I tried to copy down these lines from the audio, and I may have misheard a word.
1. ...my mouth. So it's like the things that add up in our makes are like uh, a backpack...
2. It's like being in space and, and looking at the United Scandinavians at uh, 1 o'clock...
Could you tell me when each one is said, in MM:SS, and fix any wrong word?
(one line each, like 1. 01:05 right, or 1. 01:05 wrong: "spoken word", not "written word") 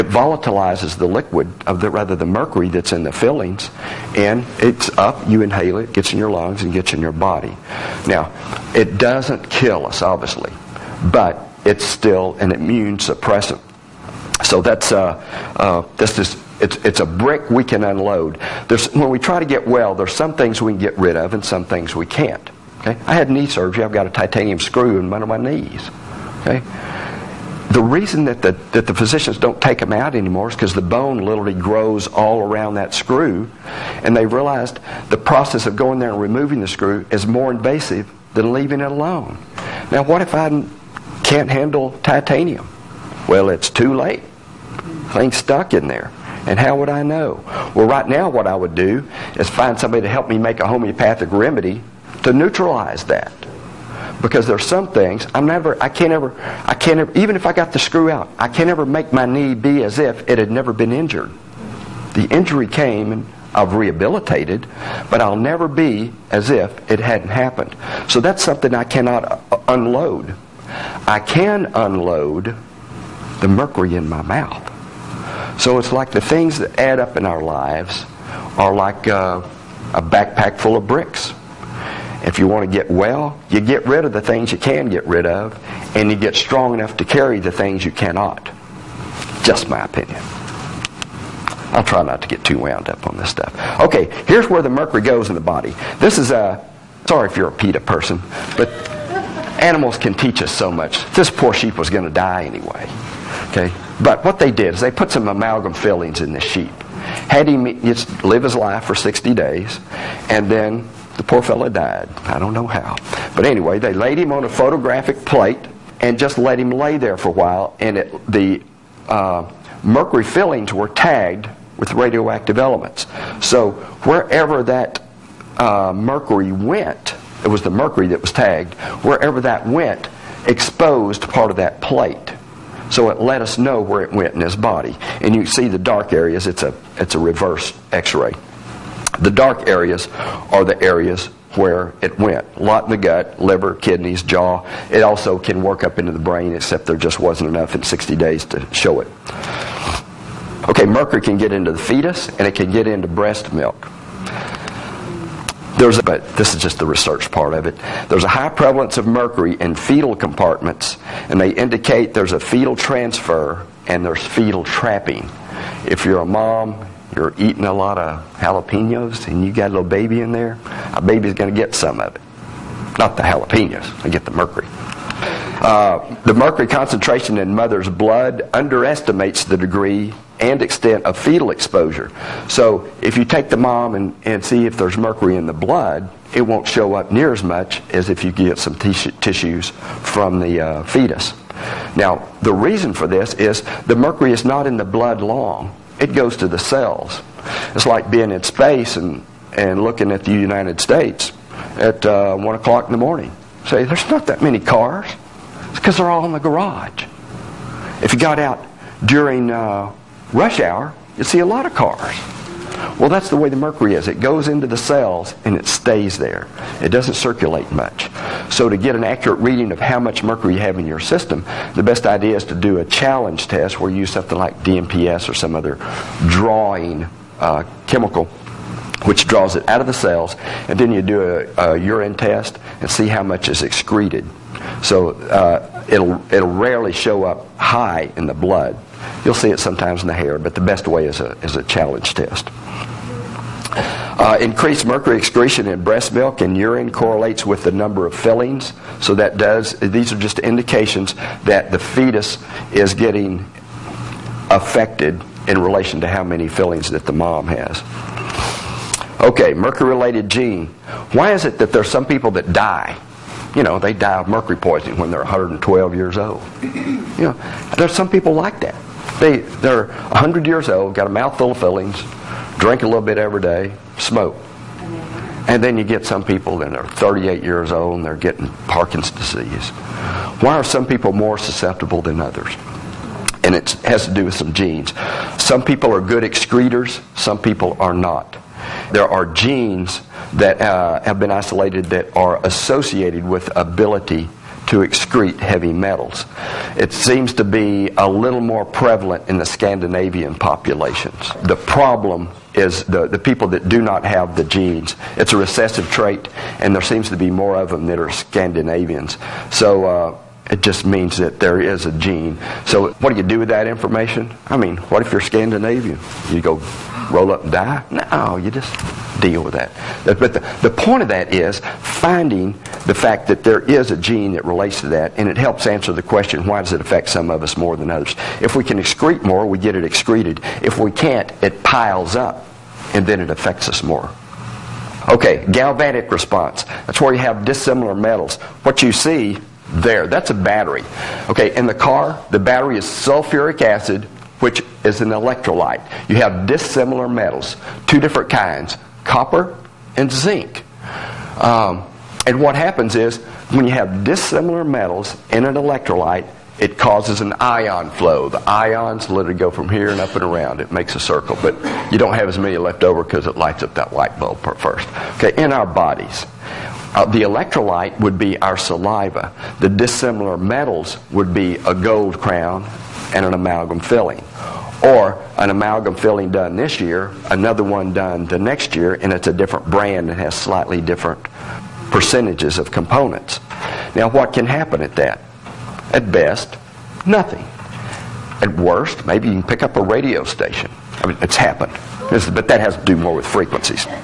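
1. 01:14 wrong: "lives", not "makes"
2. 03:17 wrong: "States", not "Scandinavians".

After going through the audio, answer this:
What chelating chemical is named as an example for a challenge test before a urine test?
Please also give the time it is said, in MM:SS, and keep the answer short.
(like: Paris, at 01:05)
DMPS, at 03:44.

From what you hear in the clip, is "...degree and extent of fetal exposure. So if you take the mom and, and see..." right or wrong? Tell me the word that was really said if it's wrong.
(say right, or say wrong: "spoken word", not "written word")
right.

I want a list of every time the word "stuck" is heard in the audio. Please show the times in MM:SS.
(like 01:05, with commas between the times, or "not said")
00:45.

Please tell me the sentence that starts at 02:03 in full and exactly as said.
So wherever that uh, mercury went, it was the mercury that was tagged, wherever that went exposed part of that plate.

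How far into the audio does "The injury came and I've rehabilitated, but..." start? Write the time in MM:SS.
01:02.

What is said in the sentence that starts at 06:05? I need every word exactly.
Okay, in our bodies, uh, the electrolyte would be our saliva.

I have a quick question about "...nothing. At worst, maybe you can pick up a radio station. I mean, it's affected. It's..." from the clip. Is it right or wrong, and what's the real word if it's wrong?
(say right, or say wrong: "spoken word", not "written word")
wrong: "happened", not "affected".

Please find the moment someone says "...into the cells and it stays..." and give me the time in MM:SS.
03:34.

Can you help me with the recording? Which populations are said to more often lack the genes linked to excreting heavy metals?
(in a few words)
Scandinavian populations.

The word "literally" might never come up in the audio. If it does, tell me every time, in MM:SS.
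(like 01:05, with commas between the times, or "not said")
00:31, 05:59.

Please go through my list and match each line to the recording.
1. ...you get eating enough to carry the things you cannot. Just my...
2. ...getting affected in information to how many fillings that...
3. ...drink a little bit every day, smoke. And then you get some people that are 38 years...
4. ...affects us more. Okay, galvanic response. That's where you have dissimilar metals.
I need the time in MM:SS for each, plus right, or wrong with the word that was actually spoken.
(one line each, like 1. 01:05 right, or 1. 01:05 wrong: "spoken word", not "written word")
1. 01:26 wrong: "strong", not "eating"
2. 04:12 wrong: "relation", not "information"
3. 04:32 right
4. 05:33 right.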